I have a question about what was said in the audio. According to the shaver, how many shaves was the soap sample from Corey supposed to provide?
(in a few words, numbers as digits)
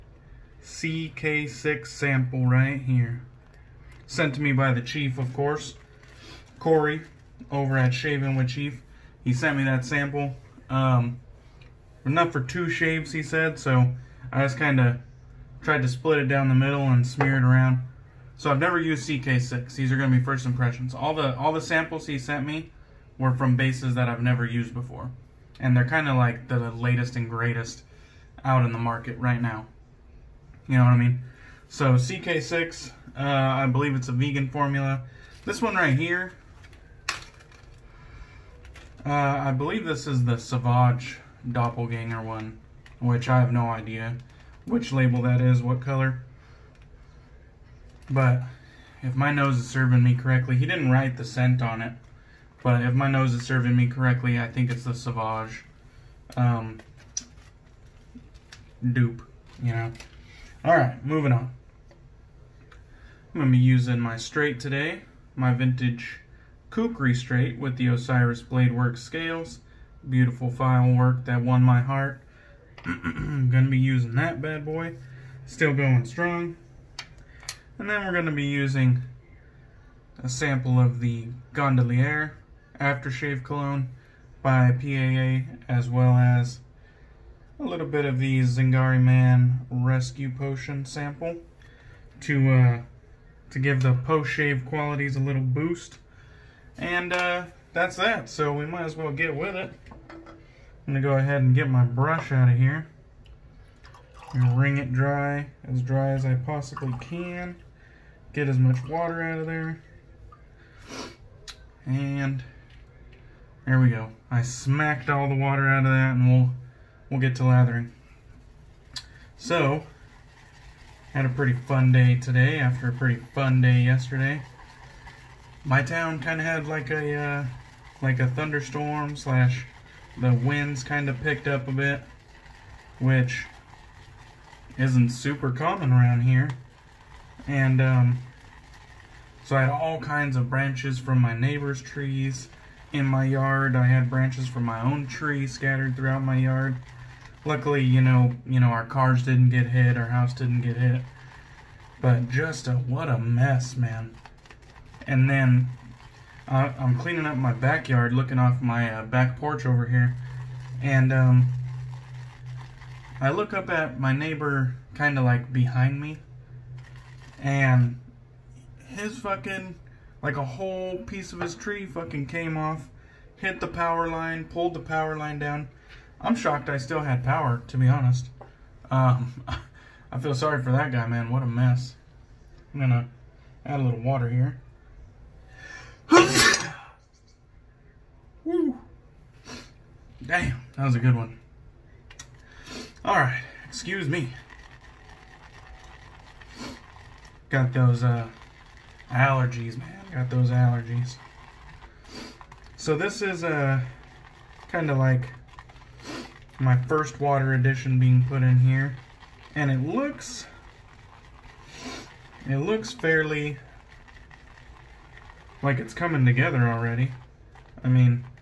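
2.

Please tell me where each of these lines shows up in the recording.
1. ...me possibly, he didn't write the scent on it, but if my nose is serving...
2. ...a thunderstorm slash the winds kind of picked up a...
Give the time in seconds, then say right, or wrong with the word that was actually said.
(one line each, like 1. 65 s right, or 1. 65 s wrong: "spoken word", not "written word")
1. 50 s wrong: "correctly", not "possibly"
2. 128 s right.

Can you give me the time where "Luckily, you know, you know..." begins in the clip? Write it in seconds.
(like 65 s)
147 s.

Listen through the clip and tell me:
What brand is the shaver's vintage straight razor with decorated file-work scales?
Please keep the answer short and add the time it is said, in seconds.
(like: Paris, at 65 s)
Kukri, at 66 s.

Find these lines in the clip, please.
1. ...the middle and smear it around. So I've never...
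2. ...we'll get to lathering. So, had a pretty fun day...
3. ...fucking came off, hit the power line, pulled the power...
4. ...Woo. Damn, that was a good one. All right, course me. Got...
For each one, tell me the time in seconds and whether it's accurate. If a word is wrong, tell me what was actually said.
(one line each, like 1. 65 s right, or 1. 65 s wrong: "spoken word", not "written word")
1. 16 s right
2. 117 s right
3. 171 s right
4. 188 s wrong: "excuse", not "course".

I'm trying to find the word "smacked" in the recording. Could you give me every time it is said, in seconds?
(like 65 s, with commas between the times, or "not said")
114 s.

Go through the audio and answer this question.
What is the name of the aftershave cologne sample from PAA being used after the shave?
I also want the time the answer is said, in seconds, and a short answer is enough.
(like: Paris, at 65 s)
Gondolier, at 81 s.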